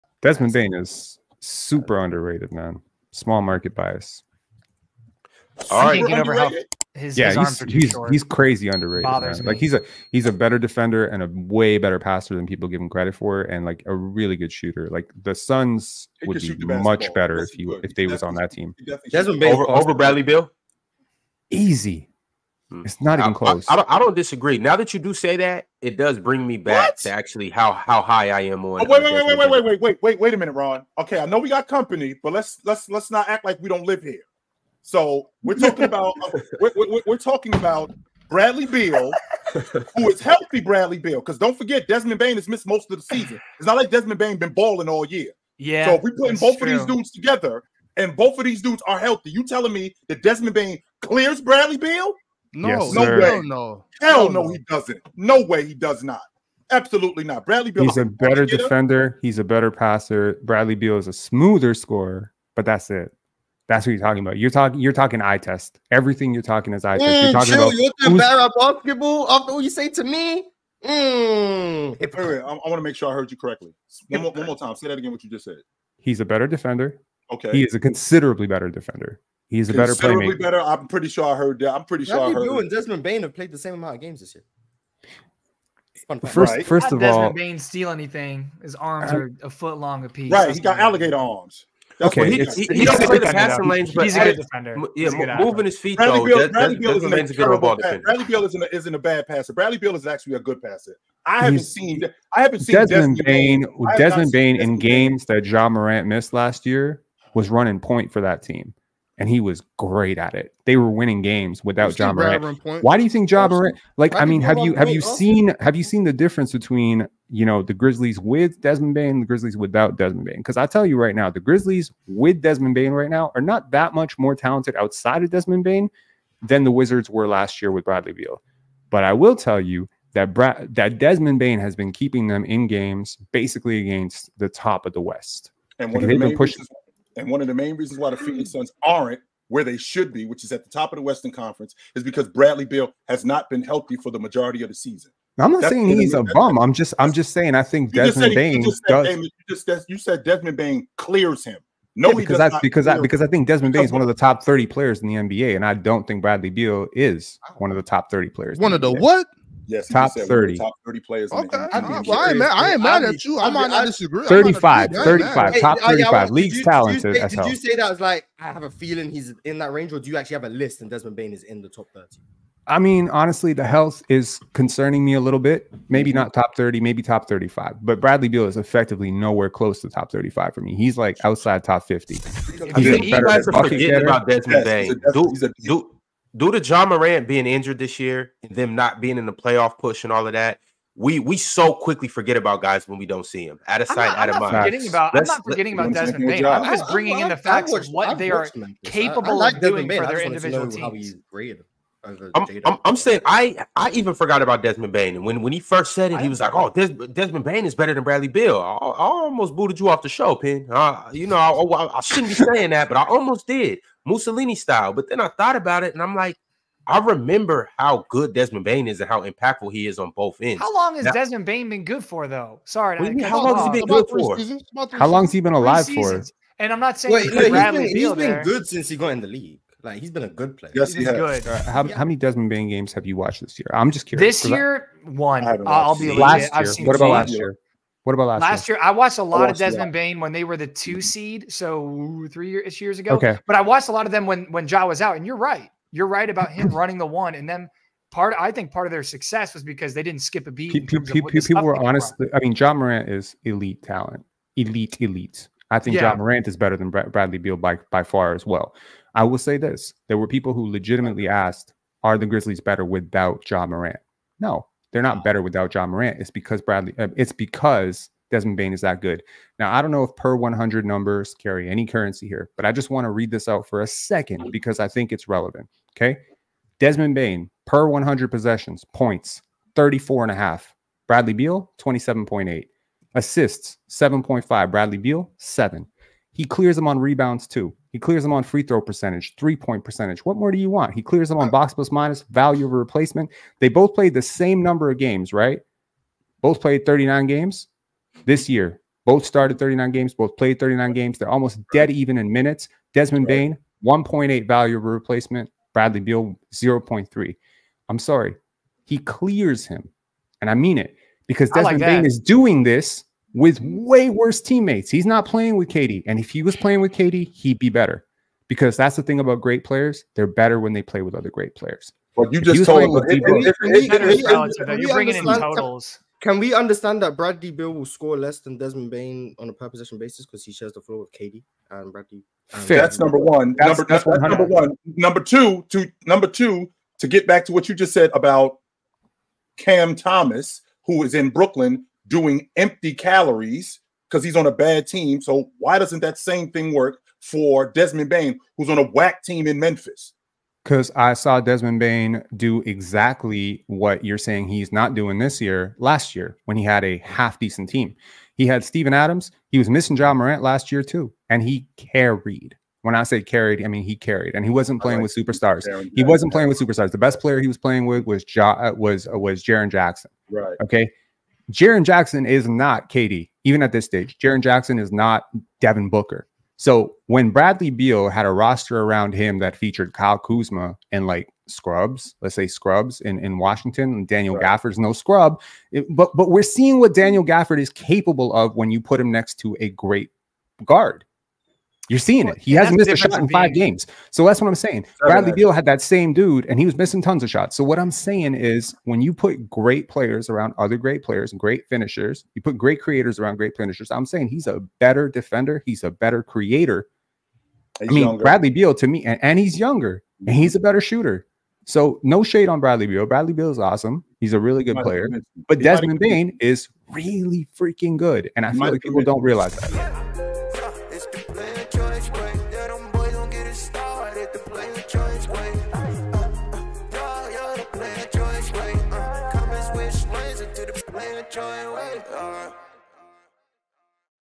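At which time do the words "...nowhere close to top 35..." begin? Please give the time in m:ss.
2:59.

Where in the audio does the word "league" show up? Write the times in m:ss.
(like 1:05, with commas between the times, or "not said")
2:46, 3:49.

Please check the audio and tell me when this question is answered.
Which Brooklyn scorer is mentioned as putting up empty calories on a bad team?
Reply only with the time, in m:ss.
5:39.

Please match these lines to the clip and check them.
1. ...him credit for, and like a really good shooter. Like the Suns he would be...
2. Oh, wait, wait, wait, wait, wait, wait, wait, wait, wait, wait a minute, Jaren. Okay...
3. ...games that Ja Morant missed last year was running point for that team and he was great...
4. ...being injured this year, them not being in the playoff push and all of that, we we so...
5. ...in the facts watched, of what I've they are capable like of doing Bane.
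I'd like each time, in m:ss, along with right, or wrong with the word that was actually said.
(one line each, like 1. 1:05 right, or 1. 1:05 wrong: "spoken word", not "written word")
1. 0:12 right
2. 0:28 wrong: "Ron", not "Jaren"
3. 1:44 right
4. 3:07 right
5. 3:17 right.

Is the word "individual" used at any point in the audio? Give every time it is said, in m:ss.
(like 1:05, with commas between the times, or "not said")
3:20.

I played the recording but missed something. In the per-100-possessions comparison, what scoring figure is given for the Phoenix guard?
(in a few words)
27.8.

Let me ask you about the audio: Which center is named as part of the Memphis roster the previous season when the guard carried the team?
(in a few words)
Steven Adams.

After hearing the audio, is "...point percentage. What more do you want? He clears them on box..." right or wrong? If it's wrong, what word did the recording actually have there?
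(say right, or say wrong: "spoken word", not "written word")
right.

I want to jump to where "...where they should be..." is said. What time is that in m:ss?
2:19.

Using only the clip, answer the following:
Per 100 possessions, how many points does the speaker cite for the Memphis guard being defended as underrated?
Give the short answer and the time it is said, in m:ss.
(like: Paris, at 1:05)
34.5, at 4:39.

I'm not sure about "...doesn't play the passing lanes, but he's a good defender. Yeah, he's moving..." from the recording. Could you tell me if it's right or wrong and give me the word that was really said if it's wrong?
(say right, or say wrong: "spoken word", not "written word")
right.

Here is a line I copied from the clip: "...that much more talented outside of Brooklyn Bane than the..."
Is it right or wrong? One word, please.
wrong.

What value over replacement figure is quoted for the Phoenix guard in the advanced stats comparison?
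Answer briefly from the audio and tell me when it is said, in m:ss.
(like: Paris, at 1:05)
0.3, at 5:06.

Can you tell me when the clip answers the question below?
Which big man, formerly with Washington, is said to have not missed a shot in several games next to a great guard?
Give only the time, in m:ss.
6:26.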